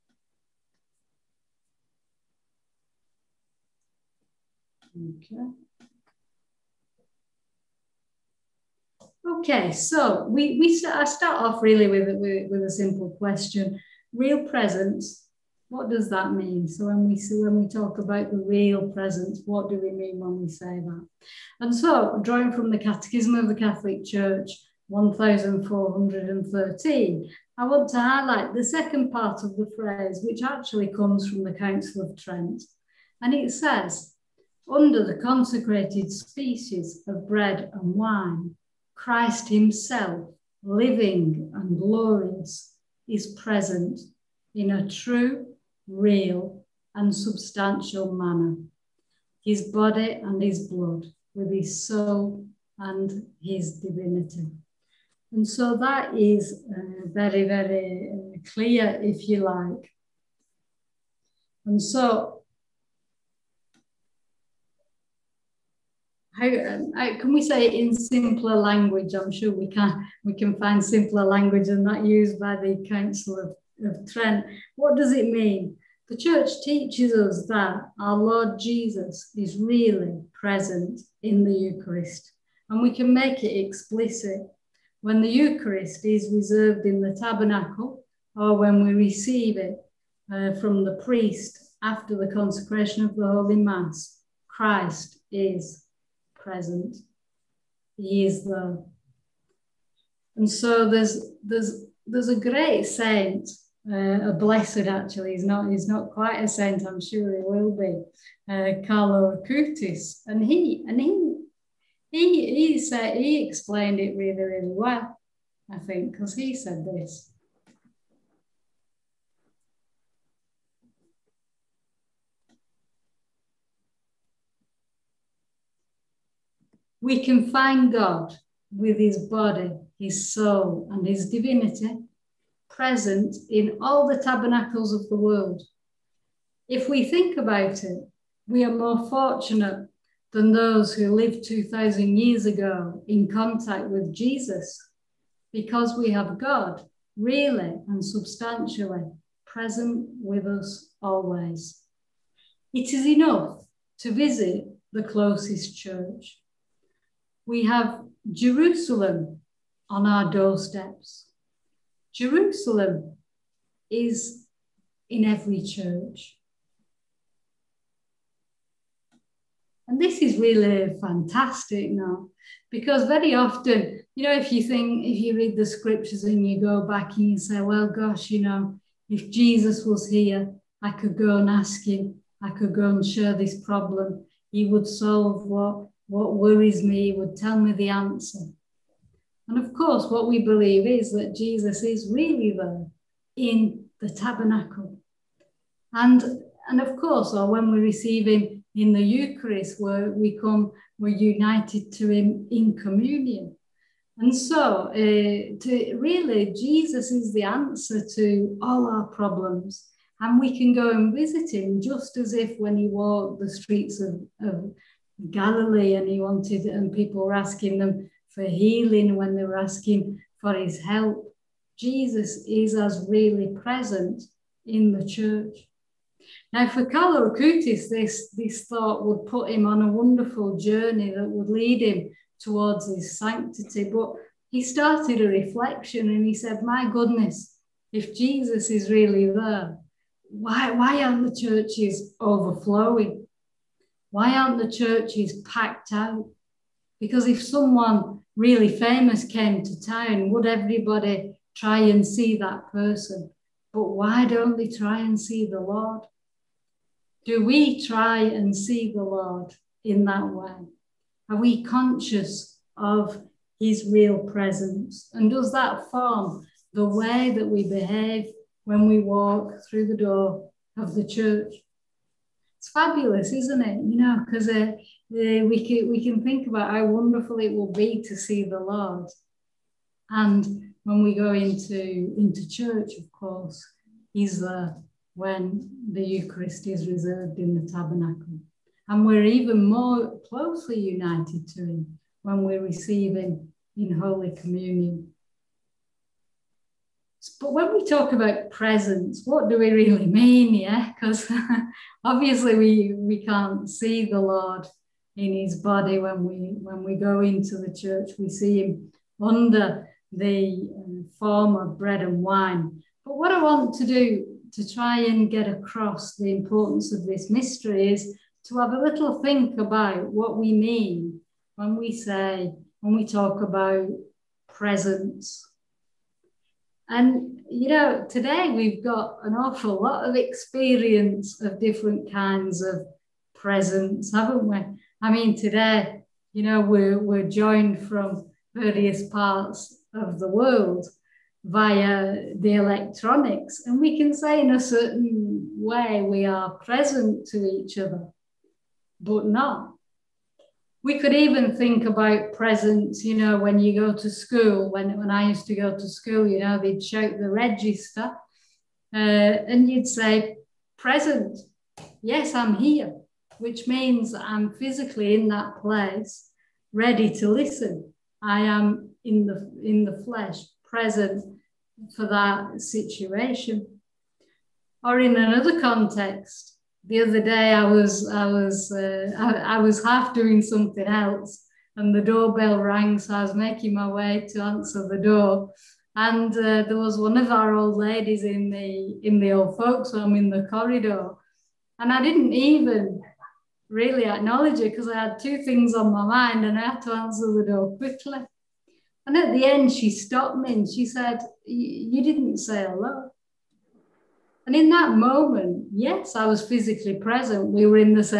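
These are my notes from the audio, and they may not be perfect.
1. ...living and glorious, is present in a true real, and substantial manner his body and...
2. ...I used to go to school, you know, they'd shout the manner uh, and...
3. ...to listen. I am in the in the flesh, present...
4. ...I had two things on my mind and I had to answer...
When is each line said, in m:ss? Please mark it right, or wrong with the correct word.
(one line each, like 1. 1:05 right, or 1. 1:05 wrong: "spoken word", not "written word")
1. 0:40 right
2. 5:55 wrong: "register", not "manner"
3. 6:07 right
4. 6:34 right.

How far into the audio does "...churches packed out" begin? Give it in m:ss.
4:04.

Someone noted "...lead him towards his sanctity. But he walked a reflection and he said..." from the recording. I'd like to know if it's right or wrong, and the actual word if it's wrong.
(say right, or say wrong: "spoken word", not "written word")
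wrong: "started", not "walked".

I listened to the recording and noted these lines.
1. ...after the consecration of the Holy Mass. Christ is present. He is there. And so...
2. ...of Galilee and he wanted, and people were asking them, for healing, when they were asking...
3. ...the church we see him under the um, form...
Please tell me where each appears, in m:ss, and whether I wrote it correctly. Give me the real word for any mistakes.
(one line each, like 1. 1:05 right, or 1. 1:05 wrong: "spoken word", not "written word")
1. 1:31 right
2. 3:34 right
3. 5:07 right.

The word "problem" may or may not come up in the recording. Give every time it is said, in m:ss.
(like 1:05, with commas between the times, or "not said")
3:03, 3:29.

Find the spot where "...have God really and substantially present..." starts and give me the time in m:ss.
2:26.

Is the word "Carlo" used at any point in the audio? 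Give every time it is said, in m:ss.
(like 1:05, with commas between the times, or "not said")
1:48, 3:46.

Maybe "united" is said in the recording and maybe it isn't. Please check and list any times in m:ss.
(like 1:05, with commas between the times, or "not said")
3:21, 4:50.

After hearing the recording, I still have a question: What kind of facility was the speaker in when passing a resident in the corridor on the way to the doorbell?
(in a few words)
old folks home.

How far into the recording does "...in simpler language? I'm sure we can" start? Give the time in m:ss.
1:07.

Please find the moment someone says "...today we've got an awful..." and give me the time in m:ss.
5:28.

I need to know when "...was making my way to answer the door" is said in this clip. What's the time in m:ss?
6:23.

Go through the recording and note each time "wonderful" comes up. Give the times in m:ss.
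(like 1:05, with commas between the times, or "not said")
3:49, 4:36.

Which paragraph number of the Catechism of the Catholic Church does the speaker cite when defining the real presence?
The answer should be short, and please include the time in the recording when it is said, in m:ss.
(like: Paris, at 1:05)
1413, at 0:24.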